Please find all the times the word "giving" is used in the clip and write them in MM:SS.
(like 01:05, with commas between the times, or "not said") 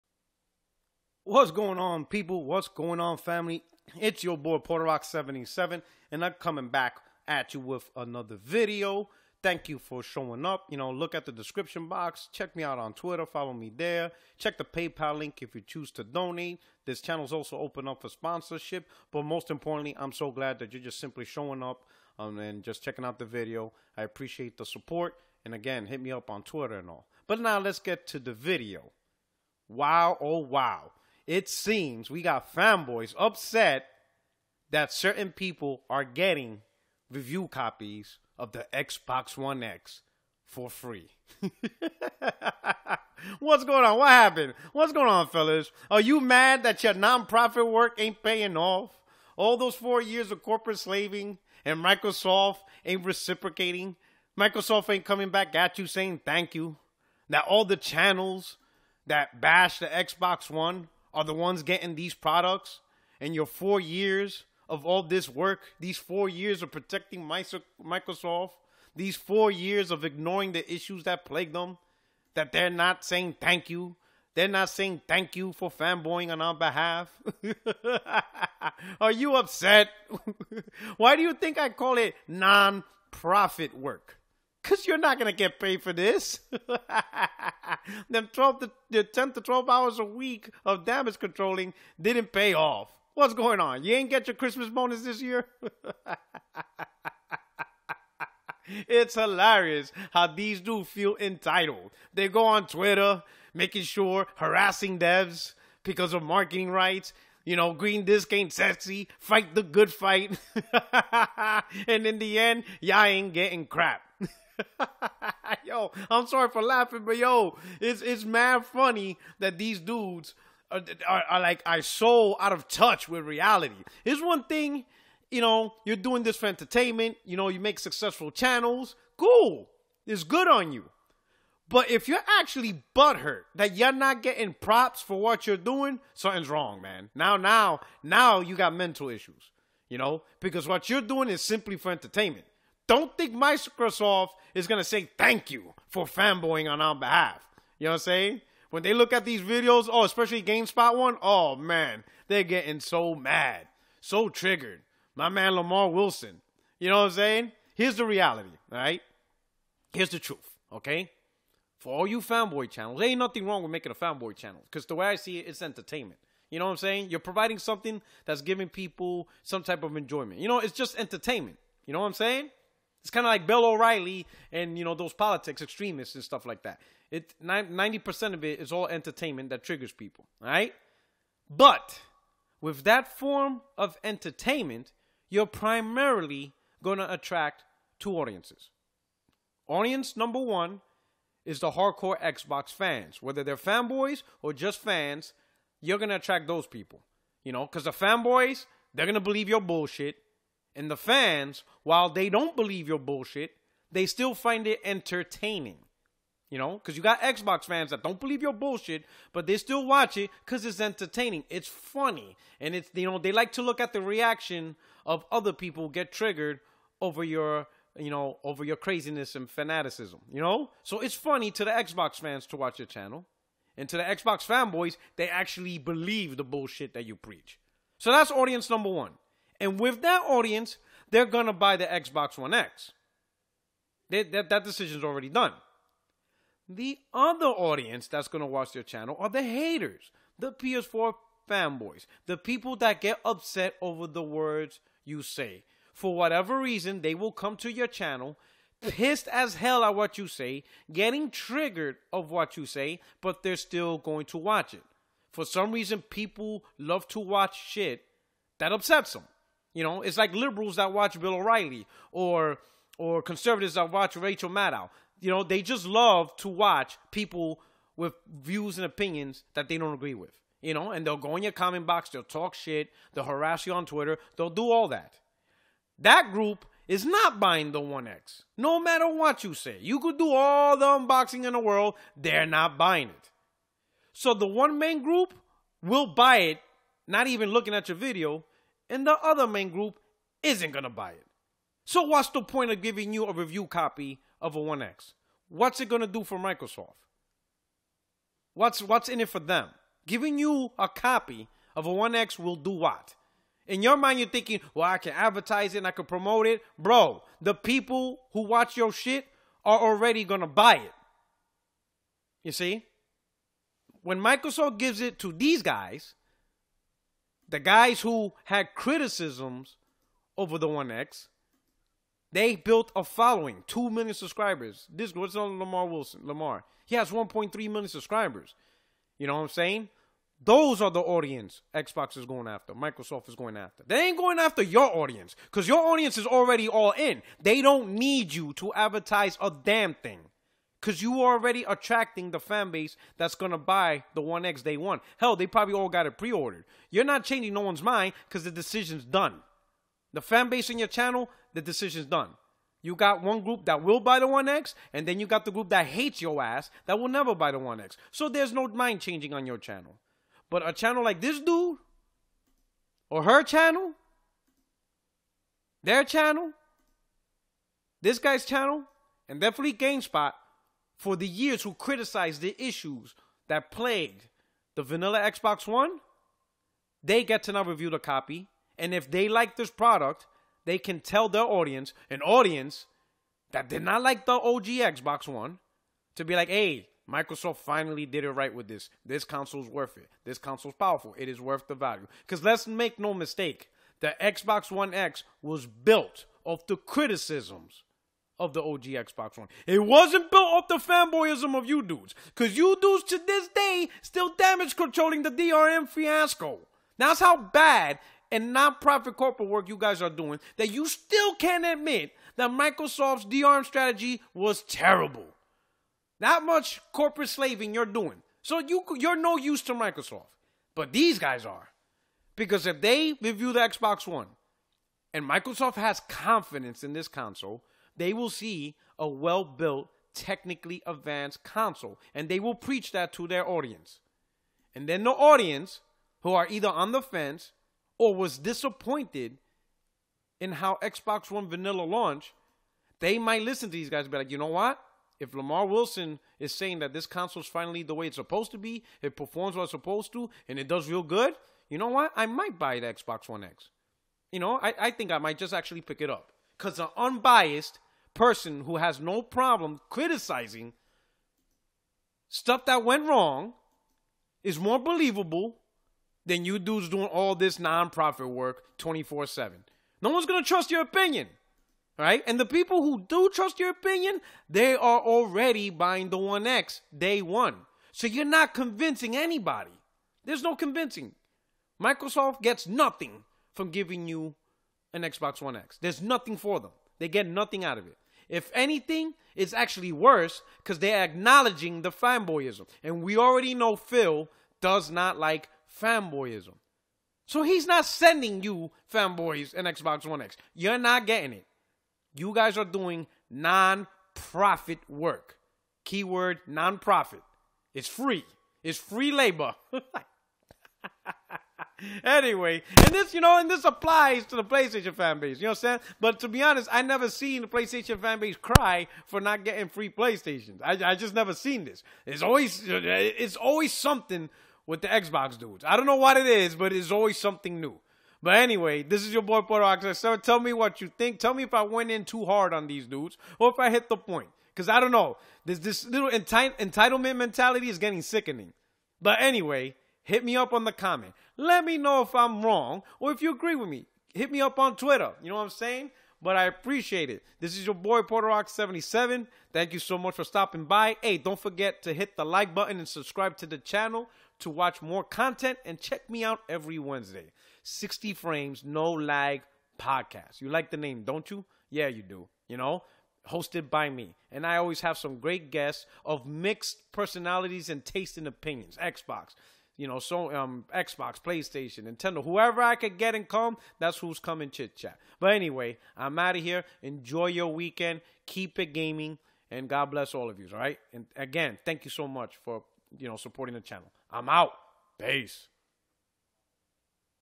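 02:48, 04:52, 05:00, 08:03.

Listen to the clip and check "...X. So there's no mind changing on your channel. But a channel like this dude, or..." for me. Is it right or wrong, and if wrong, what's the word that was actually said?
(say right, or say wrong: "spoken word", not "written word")
right.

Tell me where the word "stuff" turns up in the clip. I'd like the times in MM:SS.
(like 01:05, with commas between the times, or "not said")
02:56, 07:42.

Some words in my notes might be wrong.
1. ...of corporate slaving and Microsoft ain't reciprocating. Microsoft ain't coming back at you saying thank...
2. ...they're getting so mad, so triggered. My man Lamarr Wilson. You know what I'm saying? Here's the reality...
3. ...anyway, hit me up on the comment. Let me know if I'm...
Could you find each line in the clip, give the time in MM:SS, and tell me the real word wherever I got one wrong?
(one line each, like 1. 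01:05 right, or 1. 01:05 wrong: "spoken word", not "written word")
1. 00:50 right
2. 02:32 right
3. 08:59 right.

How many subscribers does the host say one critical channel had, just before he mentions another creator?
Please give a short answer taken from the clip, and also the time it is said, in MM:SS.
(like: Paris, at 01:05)
2 million, at 05:23.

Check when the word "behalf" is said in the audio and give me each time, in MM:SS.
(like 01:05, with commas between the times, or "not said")
01:16, 02:26.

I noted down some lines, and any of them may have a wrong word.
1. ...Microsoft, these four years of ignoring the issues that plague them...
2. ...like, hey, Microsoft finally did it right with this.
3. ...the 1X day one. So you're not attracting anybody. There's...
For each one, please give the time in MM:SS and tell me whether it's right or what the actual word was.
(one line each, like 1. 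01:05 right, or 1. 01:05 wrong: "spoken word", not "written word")
1. 01:07 right
2. 06:26 right
3. 07:56 wrong: "convincing", not "attracting".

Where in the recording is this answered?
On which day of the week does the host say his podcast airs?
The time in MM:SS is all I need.
09:16.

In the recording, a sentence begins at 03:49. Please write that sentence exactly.
And with that audience, they're going to buy the Xbox One X.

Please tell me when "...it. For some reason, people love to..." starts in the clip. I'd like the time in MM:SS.
04:14.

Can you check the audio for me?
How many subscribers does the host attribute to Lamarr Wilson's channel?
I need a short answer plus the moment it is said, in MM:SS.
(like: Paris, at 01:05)
1.3 million, at 05:27.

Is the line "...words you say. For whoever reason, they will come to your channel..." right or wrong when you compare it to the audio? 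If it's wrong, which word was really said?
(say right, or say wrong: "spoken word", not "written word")
wrong: "whatever", not "whoever".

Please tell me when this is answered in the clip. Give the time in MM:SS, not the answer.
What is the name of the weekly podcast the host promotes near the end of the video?
09:17.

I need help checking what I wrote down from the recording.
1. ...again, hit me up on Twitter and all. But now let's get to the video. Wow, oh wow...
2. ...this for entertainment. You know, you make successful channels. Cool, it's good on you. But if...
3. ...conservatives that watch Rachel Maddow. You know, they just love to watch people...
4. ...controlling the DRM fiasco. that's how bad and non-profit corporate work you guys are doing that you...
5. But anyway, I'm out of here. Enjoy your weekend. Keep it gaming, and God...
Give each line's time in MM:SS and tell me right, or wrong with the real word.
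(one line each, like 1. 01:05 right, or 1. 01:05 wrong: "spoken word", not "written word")
1. 00:25 right
2. 02:06 right
3. 04:23 right
4. 06:44 right
5. 09:35 right.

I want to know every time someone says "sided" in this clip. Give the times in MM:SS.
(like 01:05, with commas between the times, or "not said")
not said.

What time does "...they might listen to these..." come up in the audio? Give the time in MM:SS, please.
07:22.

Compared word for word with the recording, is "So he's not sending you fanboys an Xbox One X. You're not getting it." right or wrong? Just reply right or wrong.
right.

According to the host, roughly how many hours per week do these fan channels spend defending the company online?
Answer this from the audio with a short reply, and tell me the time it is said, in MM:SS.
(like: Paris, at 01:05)
10 to 12 hours, at 01:29.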